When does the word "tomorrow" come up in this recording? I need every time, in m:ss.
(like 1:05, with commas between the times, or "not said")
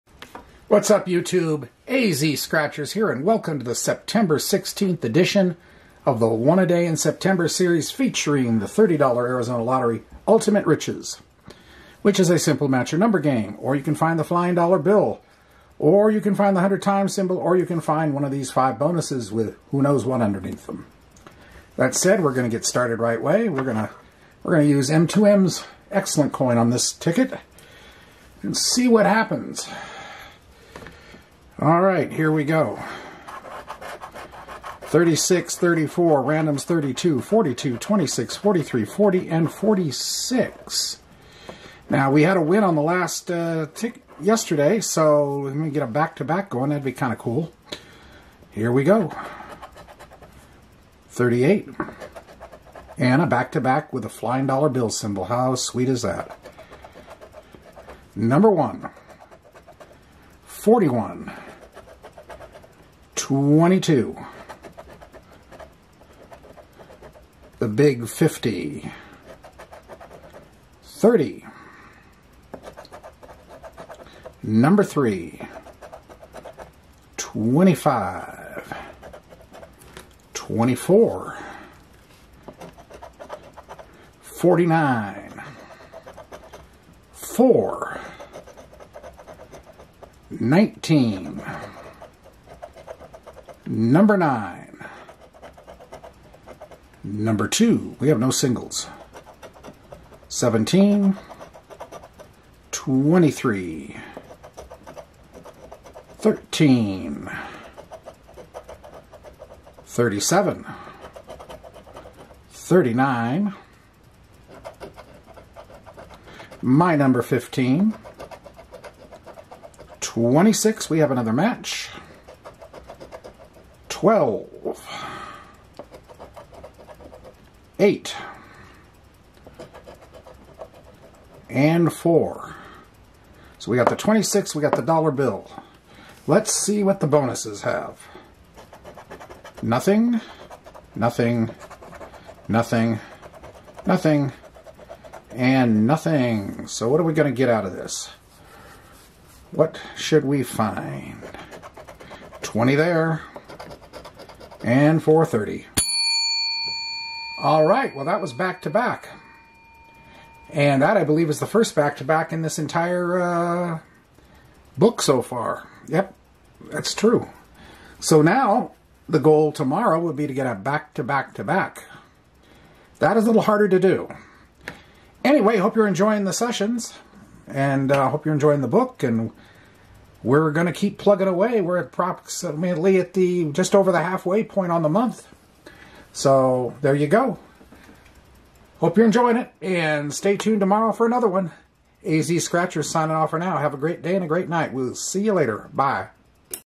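2:49, 3:10.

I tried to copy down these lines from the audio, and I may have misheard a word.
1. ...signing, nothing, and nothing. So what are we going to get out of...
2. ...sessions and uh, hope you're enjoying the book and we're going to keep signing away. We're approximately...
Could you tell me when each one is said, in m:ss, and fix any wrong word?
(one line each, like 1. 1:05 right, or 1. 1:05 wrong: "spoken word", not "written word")
1. 2:22 wrong: "nothing", not "signing"
2. 2:56 wrong: "plugging", not "signing".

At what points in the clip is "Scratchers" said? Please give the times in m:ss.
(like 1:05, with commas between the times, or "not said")
0:02, 3:12.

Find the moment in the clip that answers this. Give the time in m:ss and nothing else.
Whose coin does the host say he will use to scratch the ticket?
0:24.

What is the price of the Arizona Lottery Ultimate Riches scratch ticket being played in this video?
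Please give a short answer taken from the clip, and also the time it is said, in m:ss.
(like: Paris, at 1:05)
$30, at 0:08.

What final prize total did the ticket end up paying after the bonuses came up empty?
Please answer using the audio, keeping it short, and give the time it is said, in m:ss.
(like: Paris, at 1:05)
430, at 2:35.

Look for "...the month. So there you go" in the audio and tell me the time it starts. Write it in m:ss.
3:04.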